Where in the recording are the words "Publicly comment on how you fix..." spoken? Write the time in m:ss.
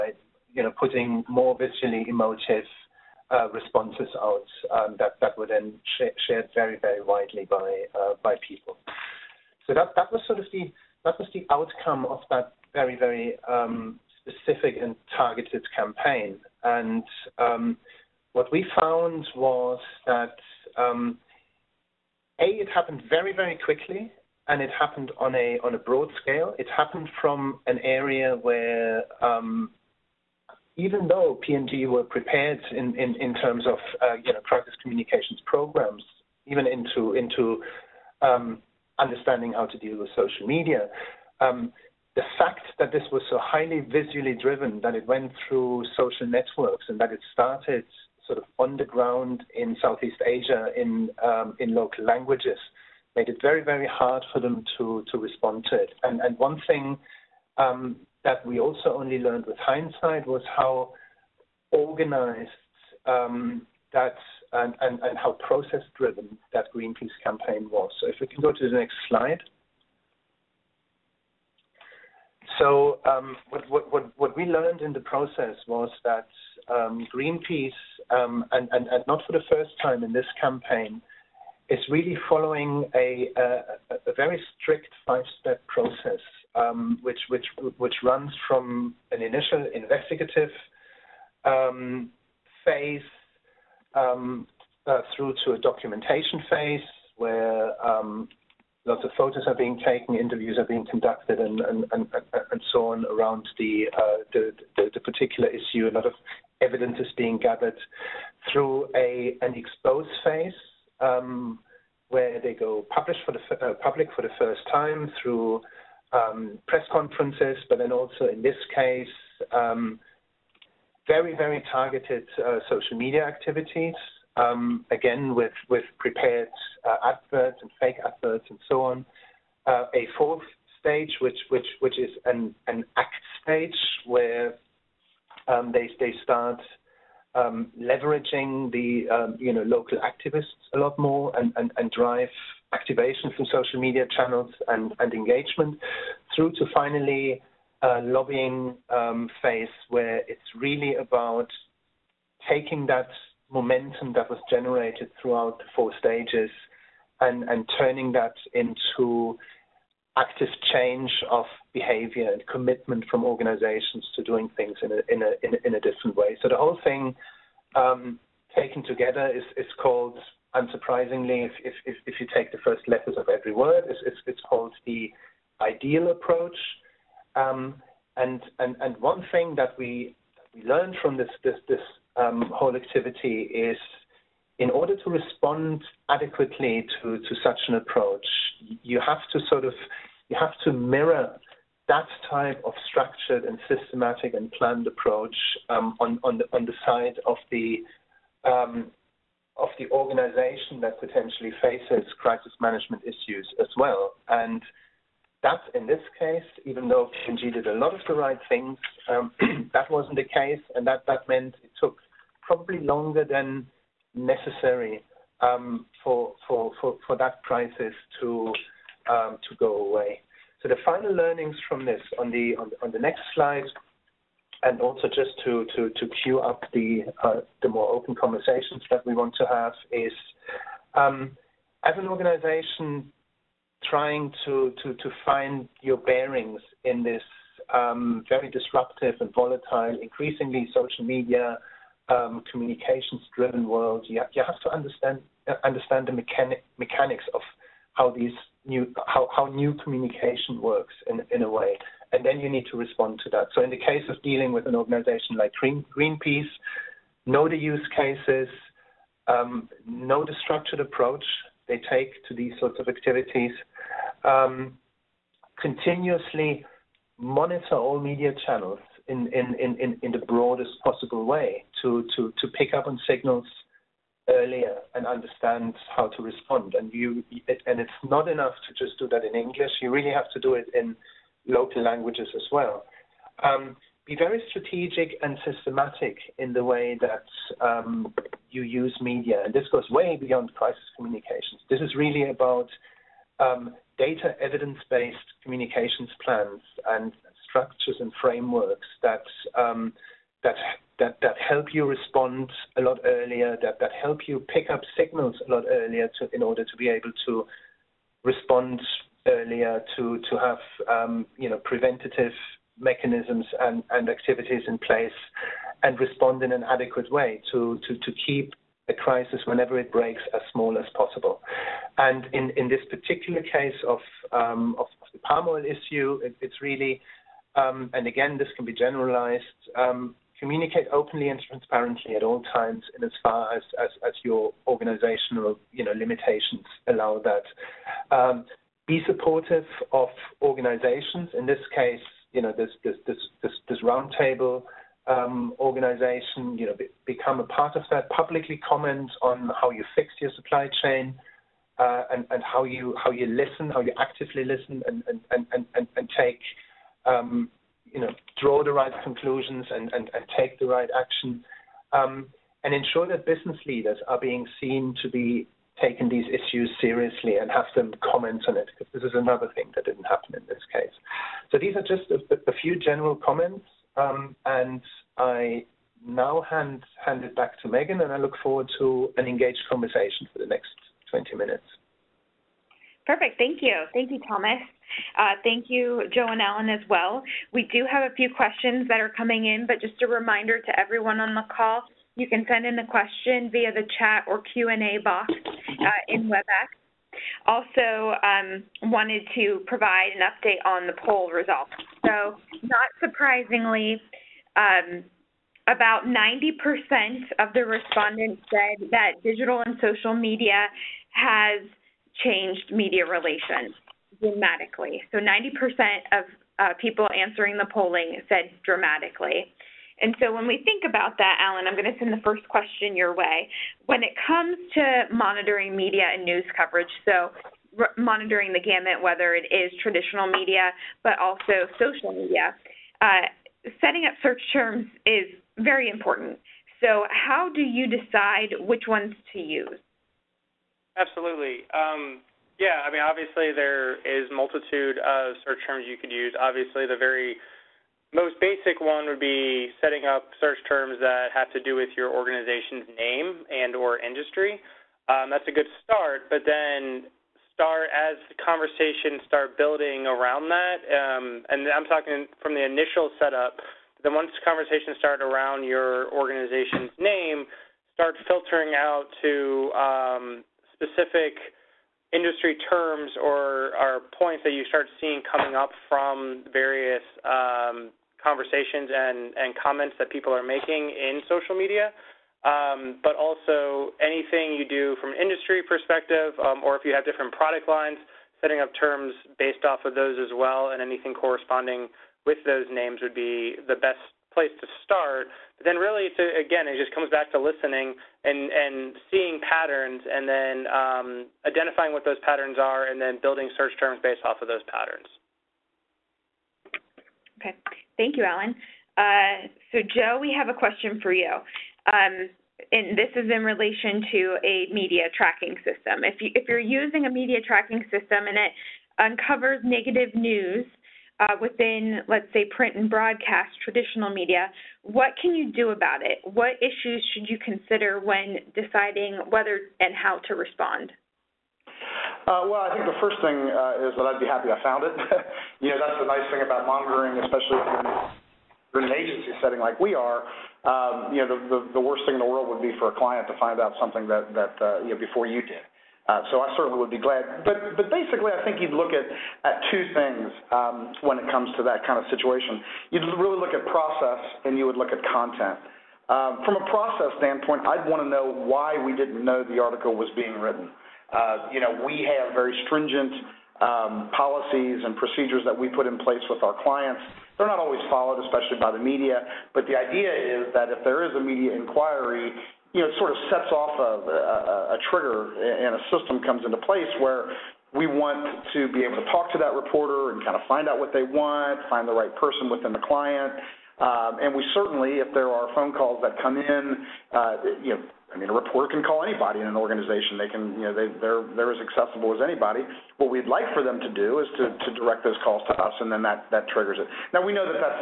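5:48.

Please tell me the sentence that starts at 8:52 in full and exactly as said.
Uh, well, I think the first thing uh, is that I'd be happy I found it.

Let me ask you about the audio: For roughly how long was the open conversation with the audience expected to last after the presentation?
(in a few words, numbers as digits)
20 minutes.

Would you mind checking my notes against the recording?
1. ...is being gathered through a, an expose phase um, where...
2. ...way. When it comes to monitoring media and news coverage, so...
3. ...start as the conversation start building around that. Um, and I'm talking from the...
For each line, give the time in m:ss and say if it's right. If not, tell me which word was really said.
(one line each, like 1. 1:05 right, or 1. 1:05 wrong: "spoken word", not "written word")
1. 1:46 right
2. 7:03 right
3. 7:37 right.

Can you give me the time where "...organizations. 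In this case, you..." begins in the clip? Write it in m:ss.
5:40.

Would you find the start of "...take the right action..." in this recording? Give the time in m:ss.
6:00.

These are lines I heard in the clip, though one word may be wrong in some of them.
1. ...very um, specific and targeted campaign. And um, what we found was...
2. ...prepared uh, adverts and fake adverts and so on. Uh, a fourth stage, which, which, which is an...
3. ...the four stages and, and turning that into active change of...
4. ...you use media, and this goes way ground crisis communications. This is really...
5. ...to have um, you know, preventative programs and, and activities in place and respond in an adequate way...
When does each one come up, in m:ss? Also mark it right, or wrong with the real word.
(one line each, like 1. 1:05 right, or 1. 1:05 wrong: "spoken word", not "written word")
1. 0:12 right
2. 2:05 right
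3. 2:35 right
4. 4:48 wrong: "beyond", not "ground"
5. 5:10 wrong: "mechanisms", not "programs".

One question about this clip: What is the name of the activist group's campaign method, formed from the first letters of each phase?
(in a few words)
the ideal approach.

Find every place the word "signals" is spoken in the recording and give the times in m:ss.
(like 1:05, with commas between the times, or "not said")
4:33, 5:04.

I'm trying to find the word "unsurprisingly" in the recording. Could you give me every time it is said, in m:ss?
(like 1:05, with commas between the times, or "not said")
2:50.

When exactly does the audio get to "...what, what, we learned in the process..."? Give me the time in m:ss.
1:13.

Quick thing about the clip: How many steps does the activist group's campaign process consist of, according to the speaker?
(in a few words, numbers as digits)
5.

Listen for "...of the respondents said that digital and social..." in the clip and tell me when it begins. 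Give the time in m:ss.
6:47.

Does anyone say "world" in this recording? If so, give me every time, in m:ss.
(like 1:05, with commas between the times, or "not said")
4:03, 9:02.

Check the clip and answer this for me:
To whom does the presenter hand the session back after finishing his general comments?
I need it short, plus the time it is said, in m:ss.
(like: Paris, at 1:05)
Megan, at 6:17.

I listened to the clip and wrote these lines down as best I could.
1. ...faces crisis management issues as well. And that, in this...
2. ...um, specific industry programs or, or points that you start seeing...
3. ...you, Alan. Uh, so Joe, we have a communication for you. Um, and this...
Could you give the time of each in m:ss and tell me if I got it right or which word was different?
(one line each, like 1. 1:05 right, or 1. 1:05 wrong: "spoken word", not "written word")
1. 3:21 right
2. 7:49 wrong: "terms", not "programs"
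3. 8:28 wrong: "question", not "communication".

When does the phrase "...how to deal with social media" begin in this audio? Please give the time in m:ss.
0:39.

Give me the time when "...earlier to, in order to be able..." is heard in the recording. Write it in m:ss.
5:05.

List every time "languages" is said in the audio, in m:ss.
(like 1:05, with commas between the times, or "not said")
0:52, 4:41.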